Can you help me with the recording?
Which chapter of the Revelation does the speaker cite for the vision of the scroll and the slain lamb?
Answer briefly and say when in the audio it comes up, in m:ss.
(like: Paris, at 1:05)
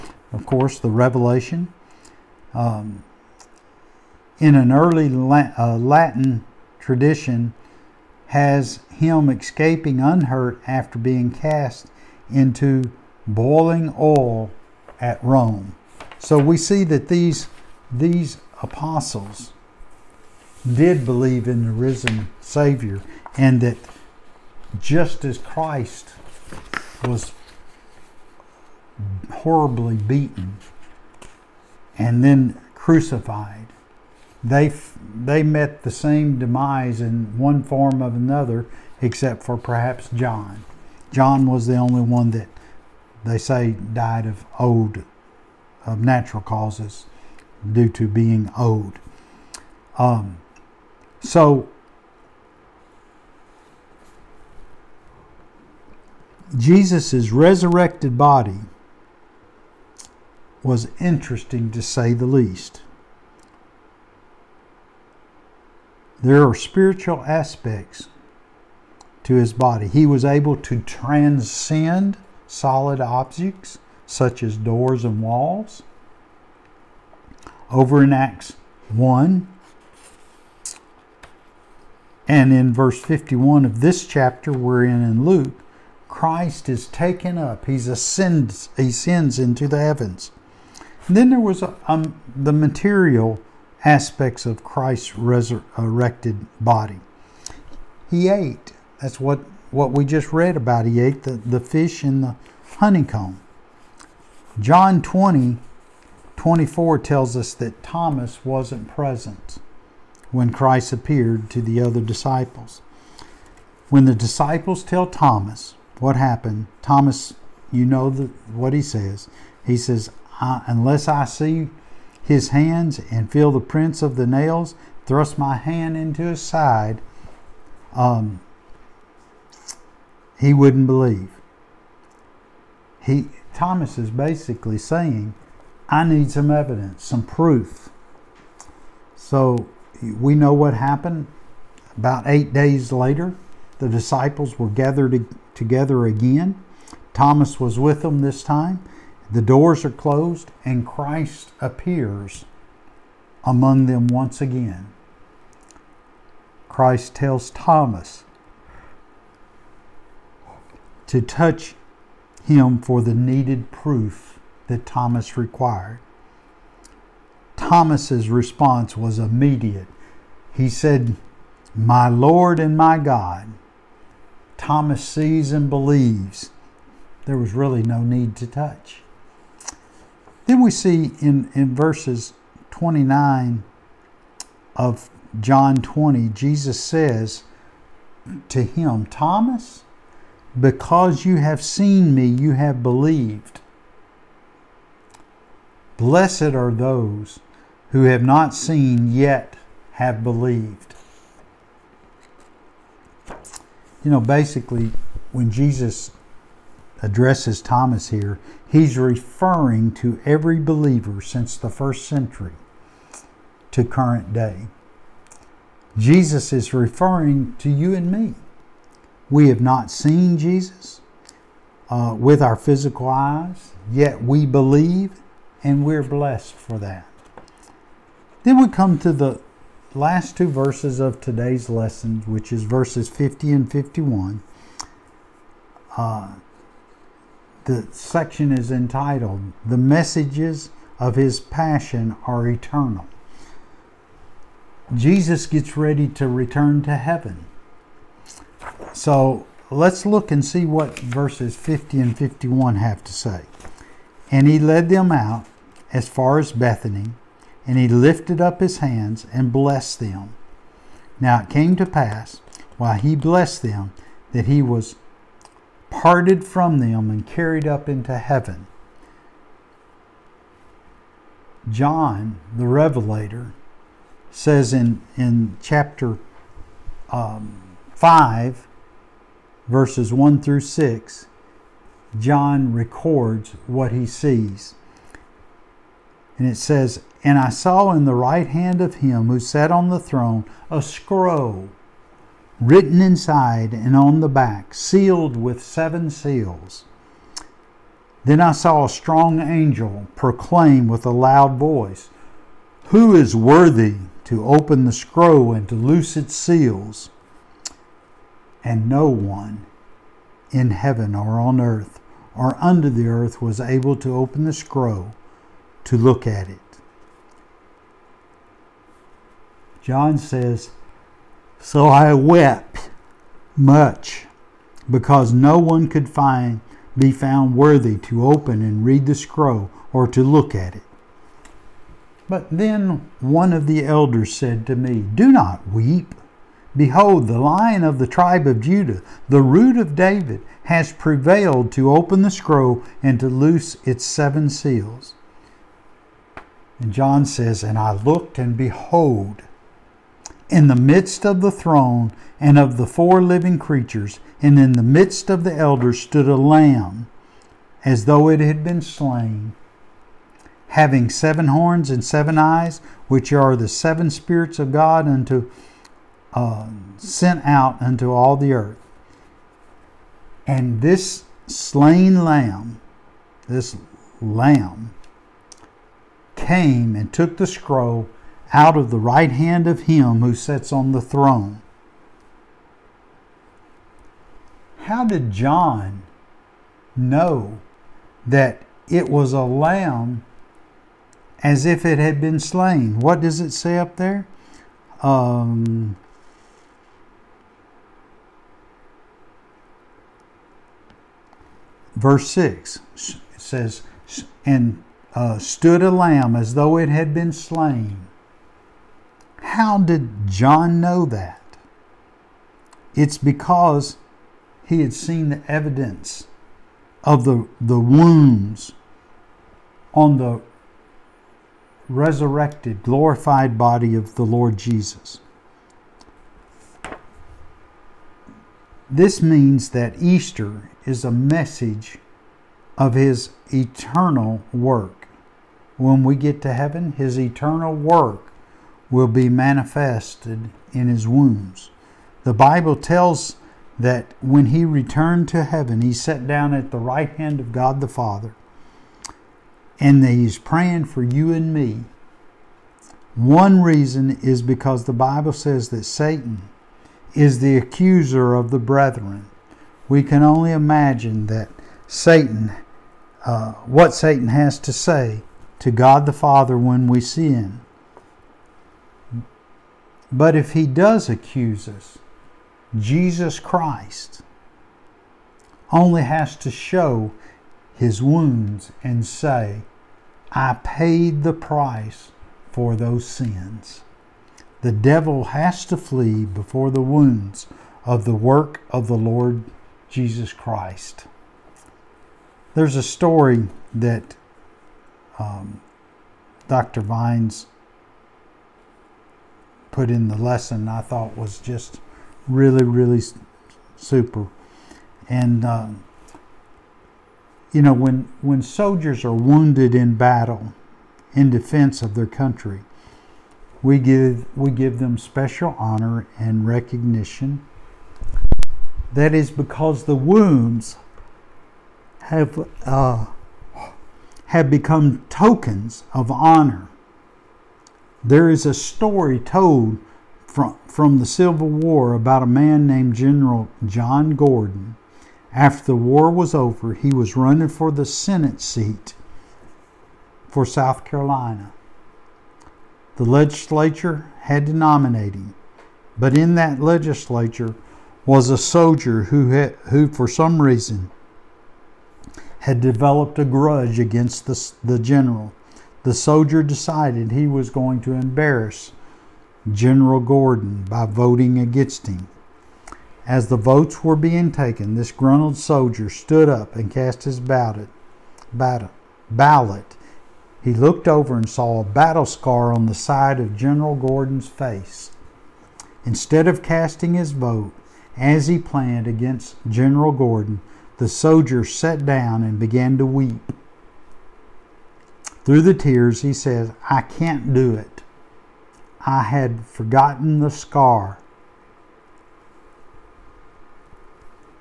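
Chapter 5, at 4:37.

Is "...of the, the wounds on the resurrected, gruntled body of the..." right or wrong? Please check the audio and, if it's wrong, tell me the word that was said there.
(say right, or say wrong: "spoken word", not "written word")
wrong: "glorified", not "gruntled".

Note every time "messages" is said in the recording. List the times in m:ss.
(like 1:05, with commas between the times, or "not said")
3:59, 7:11.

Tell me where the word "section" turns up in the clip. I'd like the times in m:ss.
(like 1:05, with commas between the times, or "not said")
3:57.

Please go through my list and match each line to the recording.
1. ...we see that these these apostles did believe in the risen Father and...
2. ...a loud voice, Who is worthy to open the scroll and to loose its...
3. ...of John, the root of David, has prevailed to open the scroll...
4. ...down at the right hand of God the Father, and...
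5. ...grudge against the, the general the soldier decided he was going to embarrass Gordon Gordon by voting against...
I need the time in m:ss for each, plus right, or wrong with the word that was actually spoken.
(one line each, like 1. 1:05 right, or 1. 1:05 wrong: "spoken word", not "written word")
1. 0:16 wrong: "Savior", not "Father"
2. 5:01 right
3. 5:38 wrong: "Judah", not "John"
4. 7:26 right
5. 9:13 wrong: "General", not "Gordon".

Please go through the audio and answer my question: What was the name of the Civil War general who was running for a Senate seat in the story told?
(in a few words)
General John Gordon.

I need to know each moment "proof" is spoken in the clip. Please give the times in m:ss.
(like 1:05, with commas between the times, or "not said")
2:17, 2:43.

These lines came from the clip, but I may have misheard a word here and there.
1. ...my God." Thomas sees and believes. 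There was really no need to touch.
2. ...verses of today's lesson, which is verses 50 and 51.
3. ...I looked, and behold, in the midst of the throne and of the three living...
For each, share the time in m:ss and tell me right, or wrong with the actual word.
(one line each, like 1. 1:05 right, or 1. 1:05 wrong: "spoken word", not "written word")
1. 2:52 right
2. 3:50 right
3. 5:47 wrong: "four", not "three".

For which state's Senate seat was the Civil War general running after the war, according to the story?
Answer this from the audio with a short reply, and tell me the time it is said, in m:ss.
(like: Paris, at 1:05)
South Carolina, at 9:00.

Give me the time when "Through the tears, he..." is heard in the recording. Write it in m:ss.
9:45.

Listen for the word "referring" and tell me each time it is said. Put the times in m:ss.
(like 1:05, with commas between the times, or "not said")
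3:28, 3:36.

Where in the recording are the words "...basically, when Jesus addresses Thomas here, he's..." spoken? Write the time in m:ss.
3:24.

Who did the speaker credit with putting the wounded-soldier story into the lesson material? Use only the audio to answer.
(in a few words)
Dr. Vines.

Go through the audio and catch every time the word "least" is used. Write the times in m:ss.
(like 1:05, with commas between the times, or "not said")
1:02.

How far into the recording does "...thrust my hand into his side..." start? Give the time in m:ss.
2:05.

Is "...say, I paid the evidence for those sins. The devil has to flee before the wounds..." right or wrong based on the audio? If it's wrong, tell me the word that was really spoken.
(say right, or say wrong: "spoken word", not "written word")
wrong: "price", not "evidence".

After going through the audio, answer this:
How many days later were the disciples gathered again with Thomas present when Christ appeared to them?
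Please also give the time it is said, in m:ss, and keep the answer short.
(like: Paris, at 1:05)
8, at 2:22.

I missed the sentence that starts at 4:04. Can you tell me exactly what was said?
Jesus gets ready to return to heaven.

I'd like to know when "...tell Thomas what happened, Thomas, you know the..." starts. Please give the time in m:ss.
1:54.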